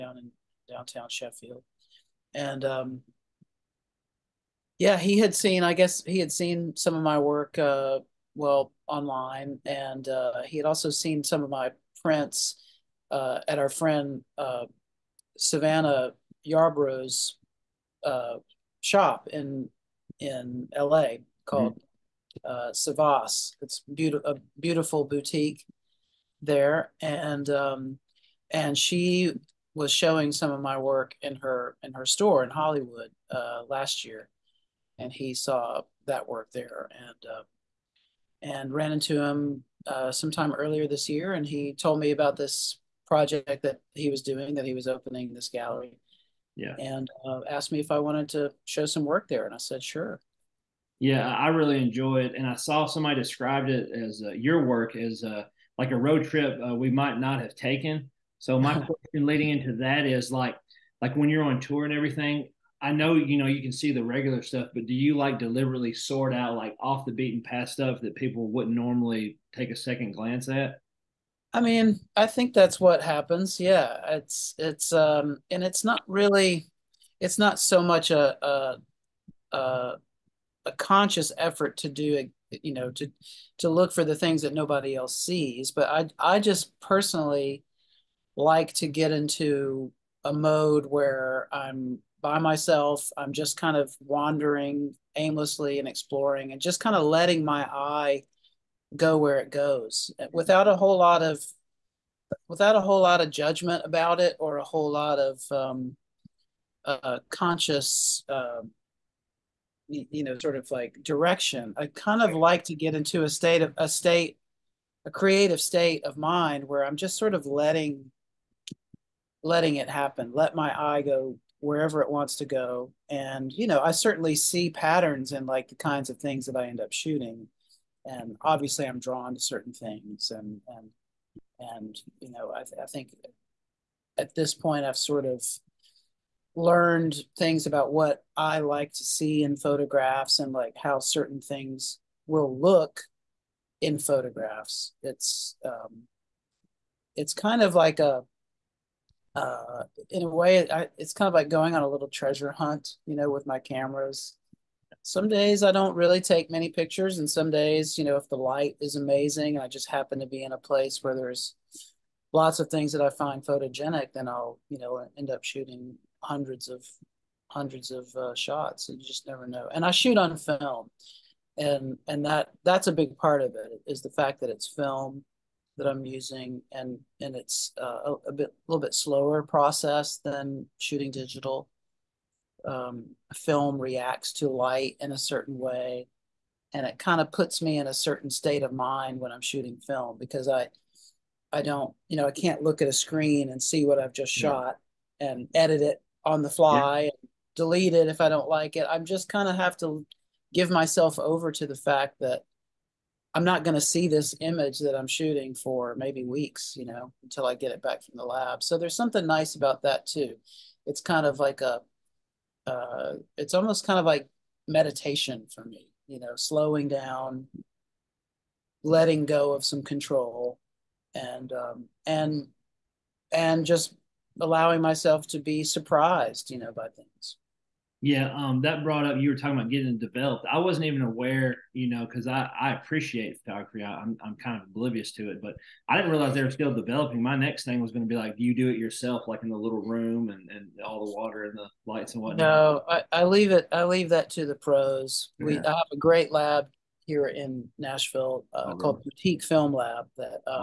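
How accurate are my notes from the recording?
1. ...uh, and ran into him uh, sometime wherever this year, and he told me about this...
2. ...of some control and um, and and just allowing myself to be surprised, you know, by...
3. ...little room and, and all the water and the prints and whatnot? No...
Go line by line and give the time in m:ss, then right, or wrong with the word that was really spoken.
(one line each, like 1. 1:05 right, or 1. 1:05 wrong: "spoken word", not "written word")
1. 0:37 wrong: "earlier", not "wherever"
2. 3:39 right
3. 3:59 wrong: "lights", not "prints".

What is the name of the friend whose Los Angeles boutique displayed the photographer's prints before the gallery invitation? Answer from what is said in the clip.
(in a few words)
Savannah Yarbrough.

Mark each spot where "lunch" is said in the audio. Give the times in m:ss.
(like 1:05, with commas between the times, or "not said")
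not said.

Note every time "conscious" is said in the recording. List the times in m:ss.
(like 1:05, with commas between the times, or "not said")
1:20, 1:47.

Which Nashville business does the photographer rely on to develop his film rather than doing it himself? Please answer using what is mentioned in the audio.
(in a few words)
Boutique Film Lab.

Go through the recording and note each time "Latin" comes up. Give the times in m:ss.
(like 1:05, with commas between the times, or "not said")
not said.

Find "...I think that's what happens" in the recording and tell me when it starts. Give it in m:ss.
1:12.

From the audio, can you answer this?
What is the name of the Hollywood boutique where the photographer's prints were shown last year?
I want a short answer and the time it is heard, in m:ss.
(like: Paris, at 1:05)
Savas, at 0:22.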